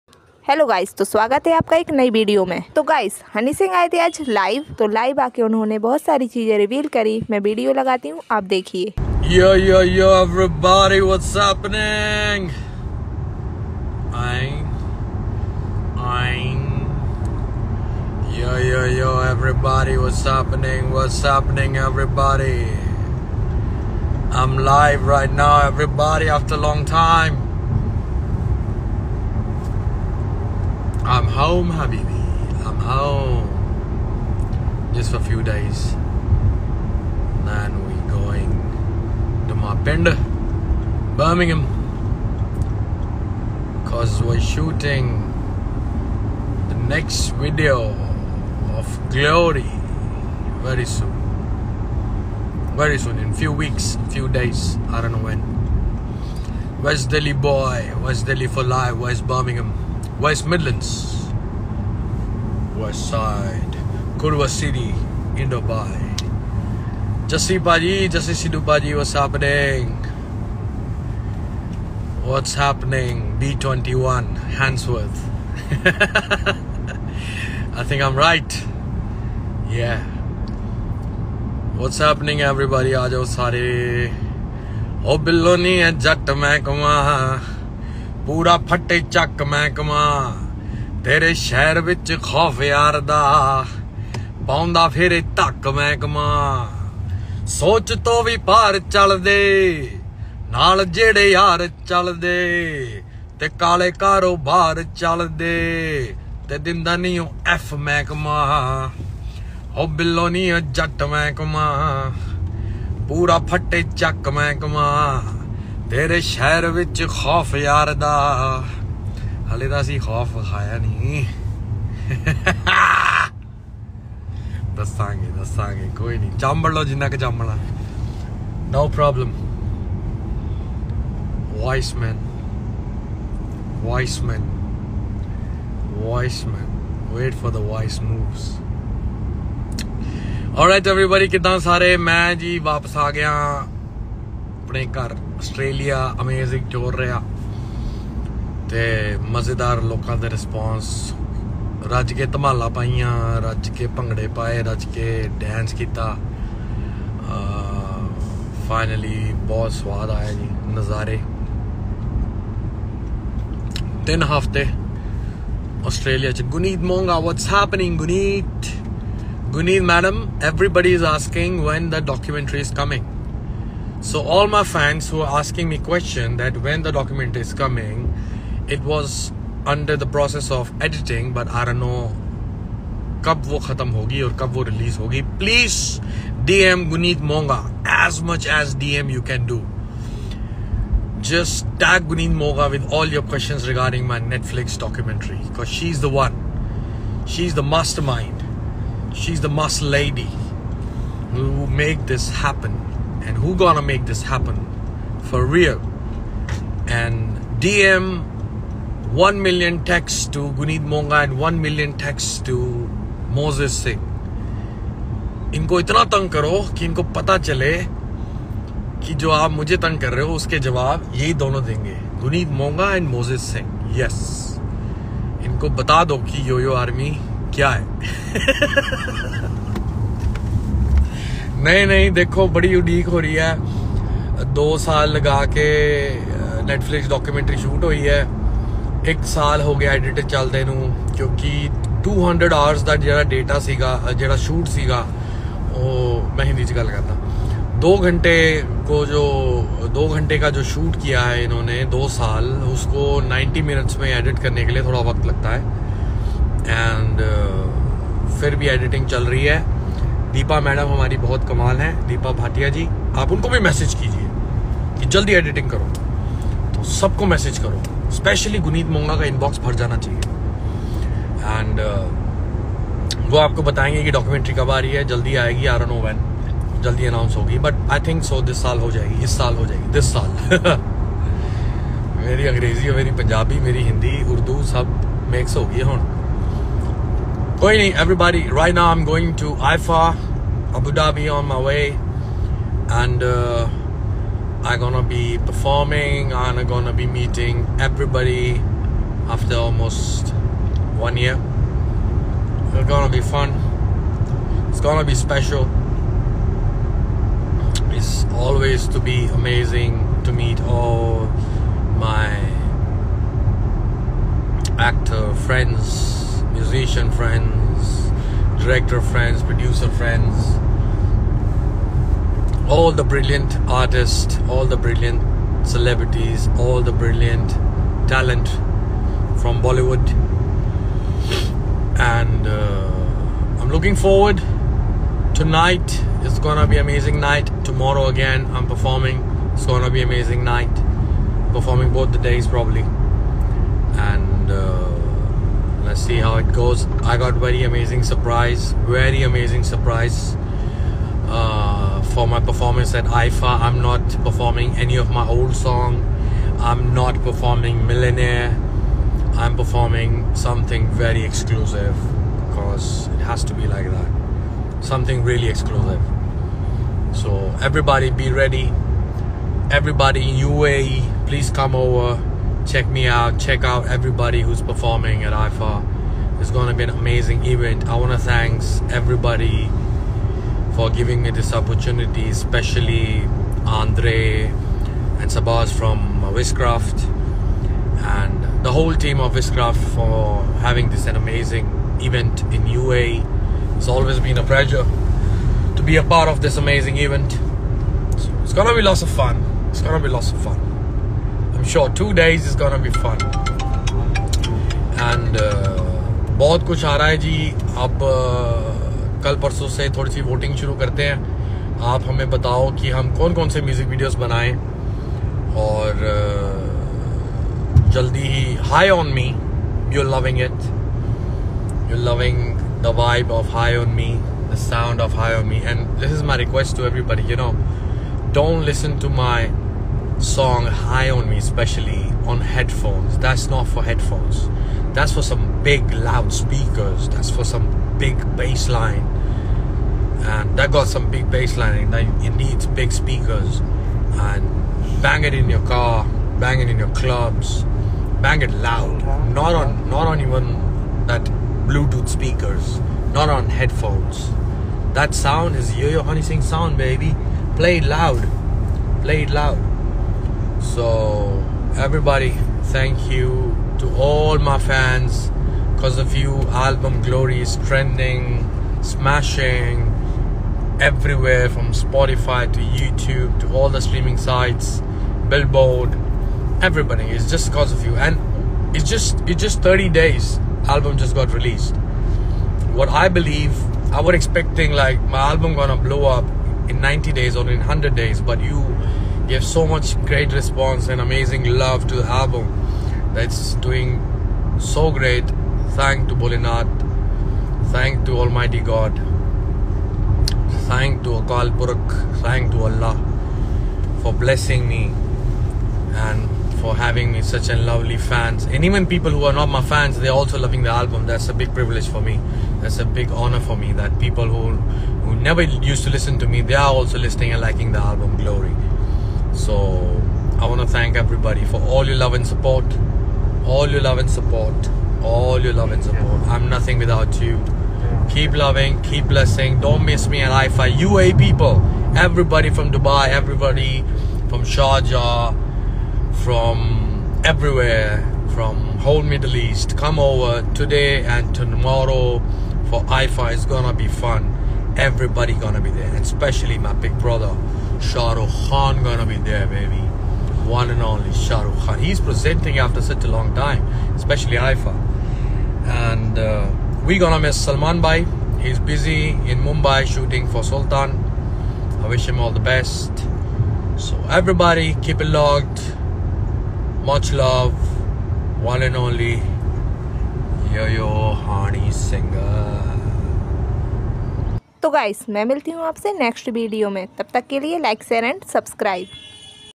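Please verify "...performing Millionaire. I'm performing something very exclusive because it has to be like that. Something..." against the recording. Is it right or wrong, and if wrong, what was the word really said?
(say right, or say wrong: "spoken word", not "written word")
right.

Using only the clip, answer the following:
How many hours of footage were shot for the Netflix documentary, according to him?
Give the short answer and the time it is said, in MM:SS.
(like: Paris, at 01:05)
200, at 04:02.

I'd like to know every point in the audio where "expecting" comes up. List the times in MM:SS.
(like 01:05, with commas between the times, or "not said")
08:04.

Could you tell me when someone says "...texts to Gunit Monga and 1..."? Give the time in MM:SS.
03:29.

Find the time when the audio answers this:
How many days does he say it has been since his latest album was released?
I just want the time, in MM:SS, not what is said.
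07:59.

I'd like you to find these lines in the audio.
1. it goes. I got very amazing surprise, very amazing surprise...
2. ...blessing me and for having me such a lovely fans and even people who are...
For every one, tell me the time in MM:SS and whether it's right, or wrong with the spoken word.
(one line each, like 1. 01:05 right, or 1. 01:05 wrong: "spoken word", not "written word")
1. 05:46 right
2. 08:24 right.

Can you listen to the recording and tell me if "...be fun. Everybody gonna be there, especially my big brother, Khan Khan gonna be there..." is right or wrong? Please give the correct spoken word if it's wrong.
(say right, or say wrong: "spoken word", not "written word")
wrong: "Shahrukh", not "Khan".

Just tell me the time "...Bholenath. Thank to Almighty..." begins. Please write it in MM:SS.
08:16.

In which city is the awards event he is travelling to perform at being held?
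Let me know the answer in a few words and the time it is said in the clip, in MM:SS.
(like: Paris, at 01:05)
Abu Dhabi, at 04:50.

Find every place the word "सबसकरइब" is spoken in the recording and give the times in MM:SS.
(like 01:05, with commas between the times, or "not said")
09:38.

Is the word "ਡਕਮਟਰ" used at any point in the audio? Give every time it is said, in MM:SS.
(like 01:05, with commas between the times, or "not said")
02:52, 03:57.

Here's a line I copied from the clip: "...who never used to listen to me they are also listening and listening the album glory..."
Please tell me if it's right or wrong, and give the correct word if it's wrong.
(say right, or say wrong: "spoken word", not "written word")
wrong: "liking", not "listening".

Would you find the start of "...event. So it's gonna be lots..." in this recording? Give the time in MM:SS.
06:36.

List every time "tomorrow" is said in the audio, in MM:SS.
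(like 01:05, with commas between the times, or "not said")
05:37, 09:01.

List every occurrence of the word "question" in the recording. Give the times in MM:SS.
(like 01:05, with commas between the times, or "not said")
02:55, 03:13.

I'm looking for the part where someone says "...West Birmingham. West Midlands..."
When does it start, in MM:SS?
00:58.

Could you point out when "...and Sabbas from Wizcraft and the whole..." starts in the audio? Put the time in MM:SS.
06:25.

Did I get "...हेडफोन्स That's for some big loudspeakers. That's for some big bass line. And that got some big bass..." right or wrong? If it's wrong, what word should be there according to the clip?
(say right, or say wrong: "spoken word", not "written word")
right.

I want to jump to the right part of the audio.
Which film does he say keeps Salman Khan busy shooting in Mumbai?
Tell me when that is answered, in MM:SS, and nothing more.
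09:20.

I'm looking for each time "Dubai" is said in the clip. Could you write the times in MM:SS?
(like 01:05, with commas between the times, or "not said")
01:05, 08:52.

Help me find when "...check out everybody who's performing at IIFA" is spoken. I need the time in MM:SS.
06:13.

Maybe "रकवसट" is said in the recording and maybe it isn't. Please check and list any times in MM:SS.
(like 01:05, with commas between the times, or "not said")
07:06.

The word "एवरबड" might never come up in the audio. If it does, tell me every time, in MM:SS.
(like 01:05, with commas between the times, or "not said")
00:10, 02:20, 07:06.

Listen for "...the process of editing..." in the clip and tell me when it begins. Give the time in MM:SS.
02:59.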